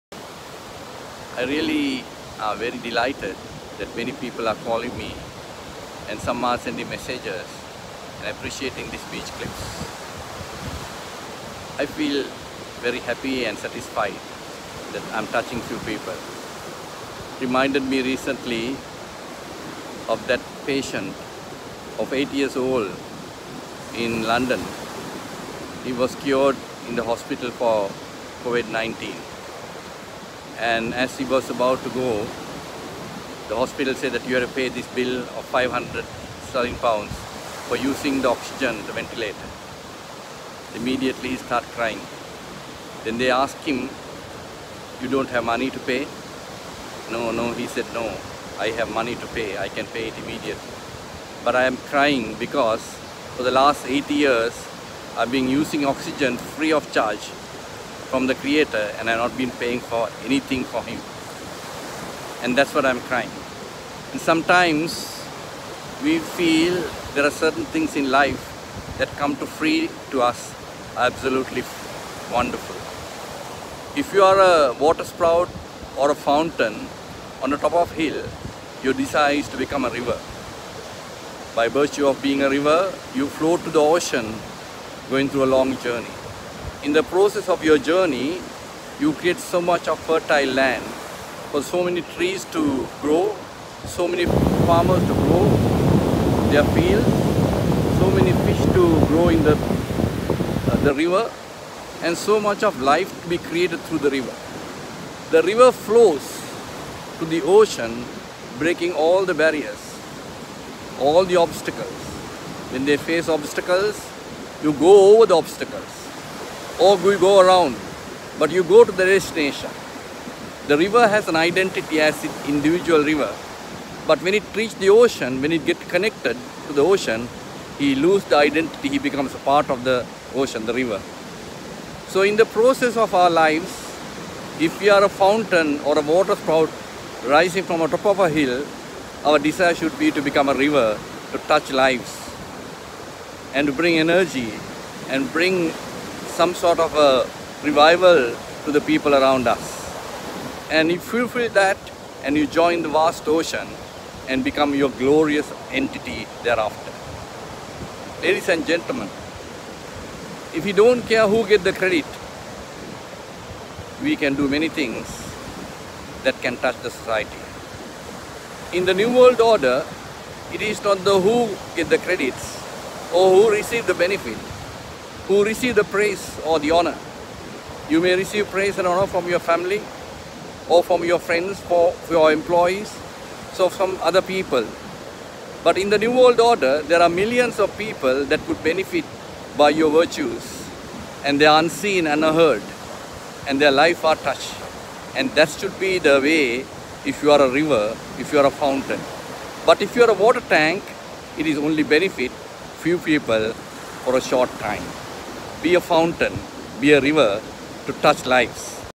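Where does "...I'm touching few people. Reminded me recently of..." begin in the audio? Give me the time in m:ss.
0:15.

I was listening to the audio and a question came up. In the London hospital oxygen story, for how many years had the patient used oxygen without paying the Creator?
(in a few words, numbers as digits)
80.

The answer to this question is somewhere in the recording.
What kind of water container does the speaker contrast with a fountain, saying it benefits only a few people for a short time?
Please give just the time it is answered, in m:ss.
3:20.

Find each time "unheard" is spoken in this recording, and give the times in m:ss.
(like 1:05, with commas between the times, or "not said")
3:12.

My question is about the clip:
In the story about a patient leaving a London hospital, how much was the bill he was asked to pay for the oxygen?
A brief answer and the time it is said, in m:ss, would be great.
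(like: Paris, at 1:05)
500 sterling pounds, at 0:35.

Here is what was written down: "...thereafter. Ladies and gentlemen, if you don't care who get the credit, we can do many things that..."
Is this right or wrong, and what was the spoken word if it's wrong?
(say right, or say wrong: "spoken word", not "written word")
right.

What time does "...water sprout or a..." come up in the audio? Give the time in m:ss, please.
1:14.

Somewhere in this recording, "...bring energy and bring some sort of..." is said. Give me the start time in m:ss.
2:23.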